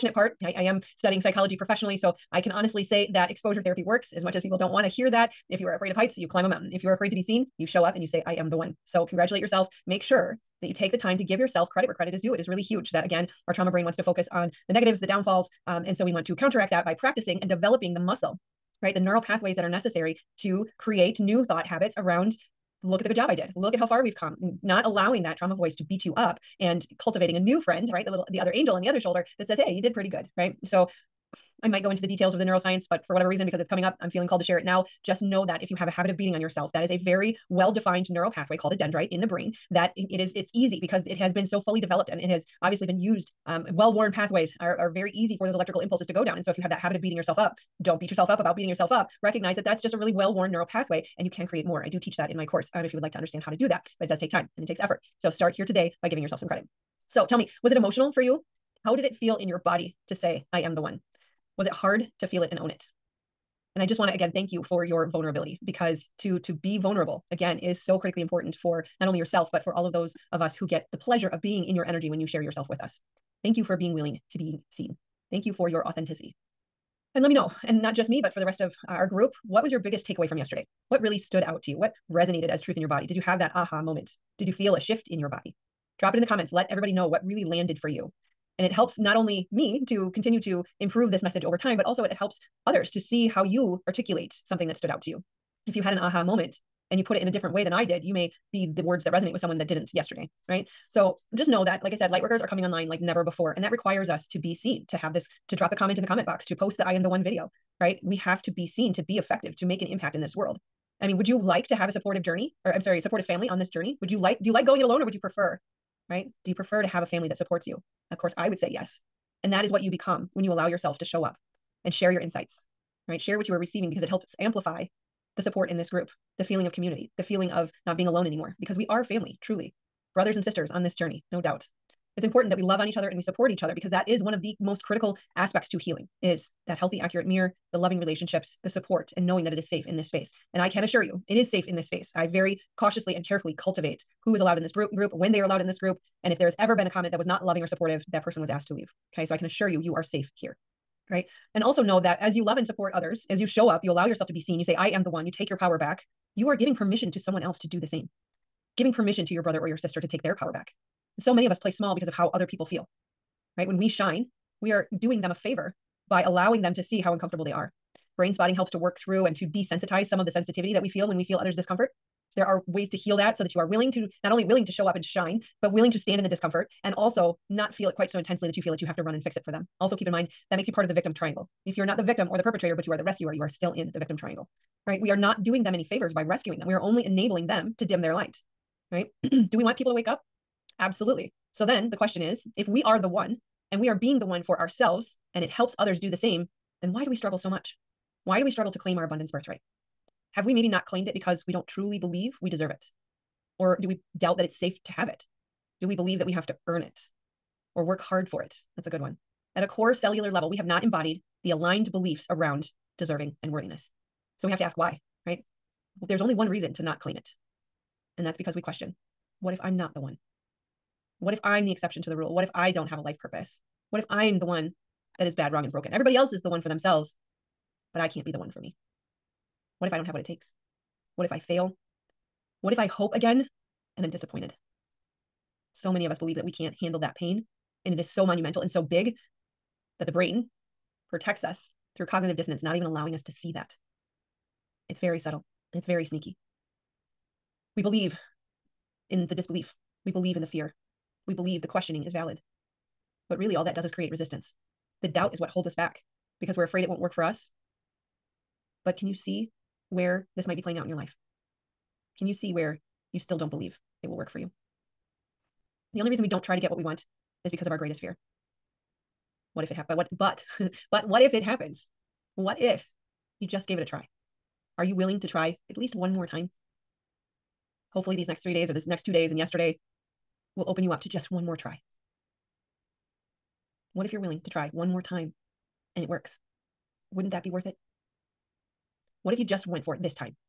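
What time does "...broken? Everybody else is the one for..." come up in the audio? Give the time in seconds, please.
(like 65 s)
225 s.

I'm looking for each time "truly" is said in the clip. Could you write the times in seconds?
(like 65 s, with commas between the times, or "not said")
129 s, 201 s.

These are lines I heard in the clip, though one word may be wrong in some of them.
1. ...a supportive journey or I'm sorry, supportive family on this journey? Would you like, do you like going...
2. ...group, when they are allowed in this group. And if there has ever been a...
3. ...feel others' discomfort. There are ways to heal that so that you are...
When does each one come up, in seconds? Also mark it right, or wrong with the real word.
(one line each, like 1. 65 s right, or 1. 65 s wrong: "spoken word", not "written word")
1. 111 s right
2. 144 s right
3. 171 s right.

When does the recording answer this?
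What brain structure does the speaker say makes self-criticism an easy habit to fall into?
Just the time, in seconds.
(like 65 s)
38 s.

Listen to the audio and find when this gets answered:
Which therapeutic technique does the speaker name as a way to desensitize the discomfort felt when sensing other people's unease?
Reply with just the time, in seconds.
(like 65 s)
168 s.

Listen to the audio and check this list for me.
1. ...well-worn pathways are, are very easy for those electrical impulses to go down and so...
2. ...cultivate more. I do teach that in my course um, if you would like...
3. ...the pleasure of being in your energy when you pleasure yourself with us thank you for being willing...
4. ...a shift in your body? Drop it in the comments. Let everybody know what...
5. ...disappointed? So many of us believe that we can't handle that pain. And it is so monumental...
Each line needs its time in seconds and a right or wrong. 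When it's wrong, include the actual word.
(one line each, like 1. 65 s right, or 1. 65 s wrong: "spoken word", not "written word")
1. 43 s right
2. 51 s wrong: "create", not "cultivate"
3. 70 s wrong: "share", not "pleasure"
4. 84 s right
5. 234 s right.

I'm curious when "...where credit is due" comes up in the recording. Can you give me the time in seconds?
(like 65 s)
11 s.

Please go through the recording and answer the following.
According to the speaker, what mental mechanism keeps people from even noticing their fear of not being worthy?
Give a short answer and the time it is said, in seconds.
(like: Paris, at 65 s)
Cognitive dissonance, at 242 s.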